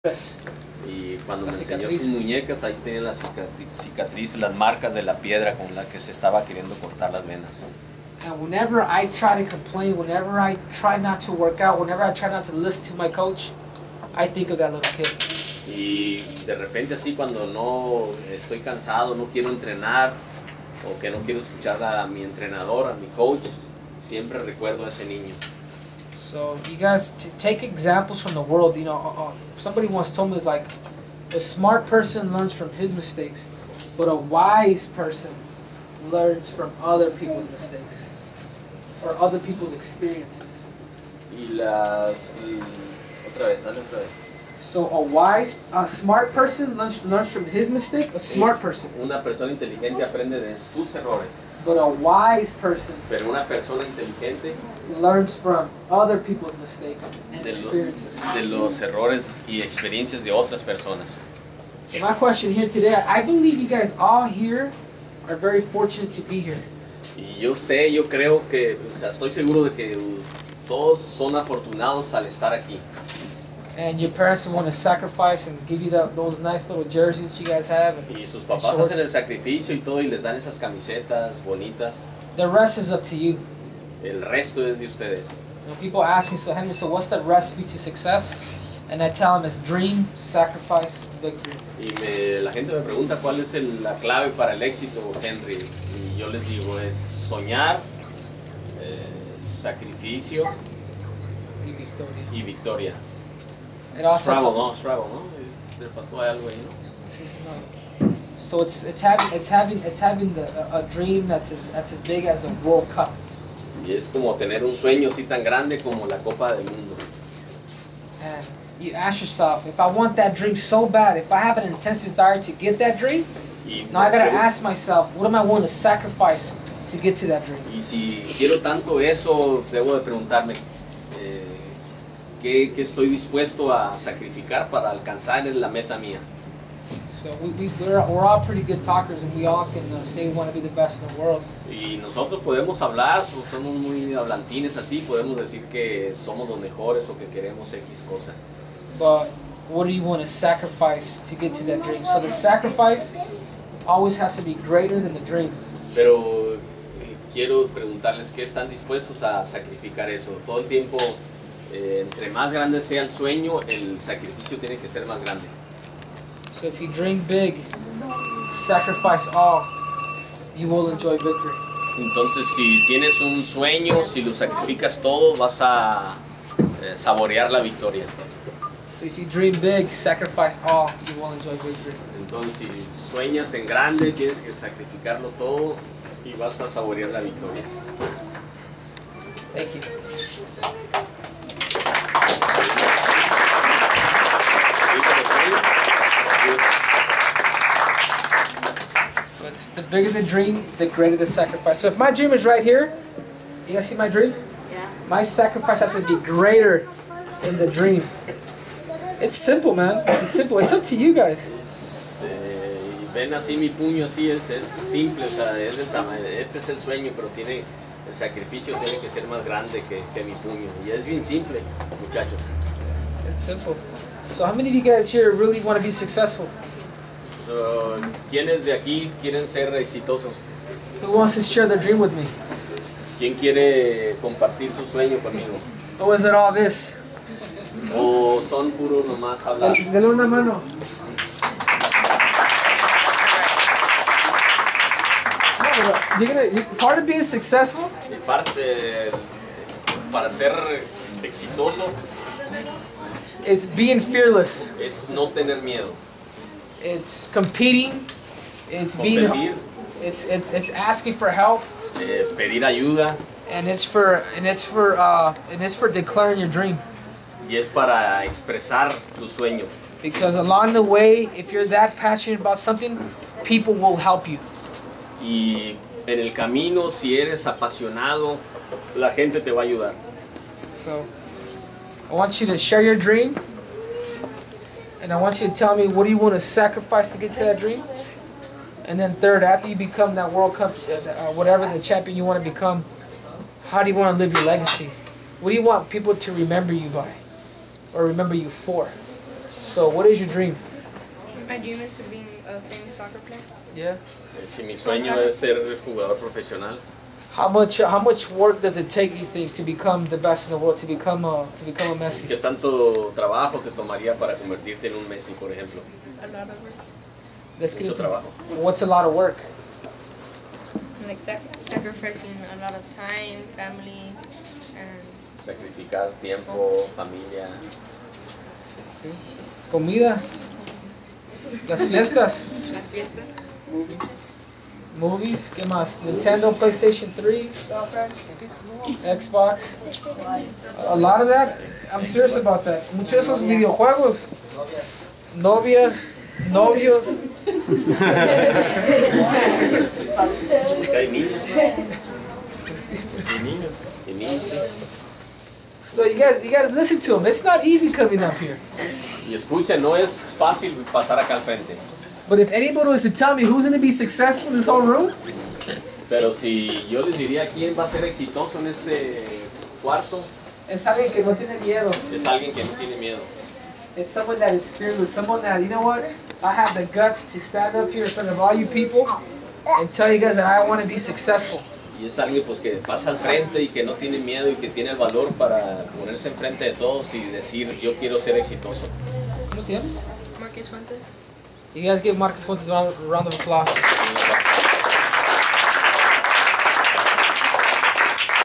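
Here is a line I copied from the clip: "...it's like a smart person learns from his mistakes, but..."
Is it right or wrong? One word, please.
right.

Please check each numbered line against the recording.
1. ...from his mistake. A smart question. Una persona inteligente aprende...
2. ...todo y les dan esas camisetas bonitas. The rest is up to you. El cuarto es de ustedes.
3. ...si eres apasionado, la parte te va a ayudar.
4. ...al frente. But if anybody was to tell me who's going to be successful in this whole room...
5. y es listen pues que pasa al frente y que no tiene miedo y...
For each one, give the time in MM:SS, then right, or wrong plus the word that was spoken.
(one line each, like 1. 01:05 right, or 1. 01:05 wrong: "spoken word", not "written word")
1. 00:47 wrong: "person", not "question"
2. 01:19 wrong: "resto", not "cuarto"
3. 04:36 wrong: "gente", not "parte"
4. 06:01 right
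5. 06:22 wrong: "alguien", not "listen".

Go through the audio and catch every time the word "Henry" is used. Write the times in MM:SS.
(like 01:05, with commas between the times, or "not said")
01:26, 01:35.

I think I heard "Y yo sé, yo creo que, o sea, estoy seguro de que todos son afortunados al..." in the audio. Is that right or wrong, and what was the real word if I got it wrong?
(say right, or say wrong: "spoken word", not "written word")
right.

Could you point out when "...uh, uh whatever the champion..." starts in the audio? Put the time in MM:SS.
04:50.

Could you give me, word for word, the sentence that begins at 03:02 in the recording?
Entonces, si sueñas en grande, tienes que sacrificarlo todo y vas a saborear la victoria.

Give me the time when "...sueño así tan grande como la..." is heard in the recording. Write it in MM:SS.
01:54.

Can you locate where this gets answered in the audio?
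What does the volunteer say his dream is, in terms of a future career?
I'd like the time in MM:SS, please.
05:02.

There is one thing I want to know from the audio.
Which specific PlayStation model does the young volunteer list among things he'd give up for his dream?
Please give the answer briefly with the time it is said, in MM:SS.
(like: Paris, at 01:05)
PlayStation 3, at 05:36.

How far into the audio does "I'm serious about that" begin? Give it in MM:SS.
05:41.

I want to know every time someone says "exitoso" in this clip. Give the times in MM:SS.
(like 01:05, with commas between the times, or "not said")
03:49, 04:11, 06:08, 06:28.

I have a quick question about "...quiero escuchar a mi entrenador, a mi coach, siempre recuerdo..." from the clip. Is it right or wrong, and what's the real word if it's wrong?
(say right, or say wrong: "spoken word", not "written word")
right.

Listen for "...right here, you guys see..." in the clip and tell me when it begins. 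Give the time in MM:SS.
03:22.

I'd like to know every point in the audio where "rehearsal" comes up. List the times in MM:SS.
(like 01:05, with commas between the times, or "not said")
not said.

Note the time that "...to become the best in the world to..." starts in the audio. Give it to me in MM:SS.
05:09.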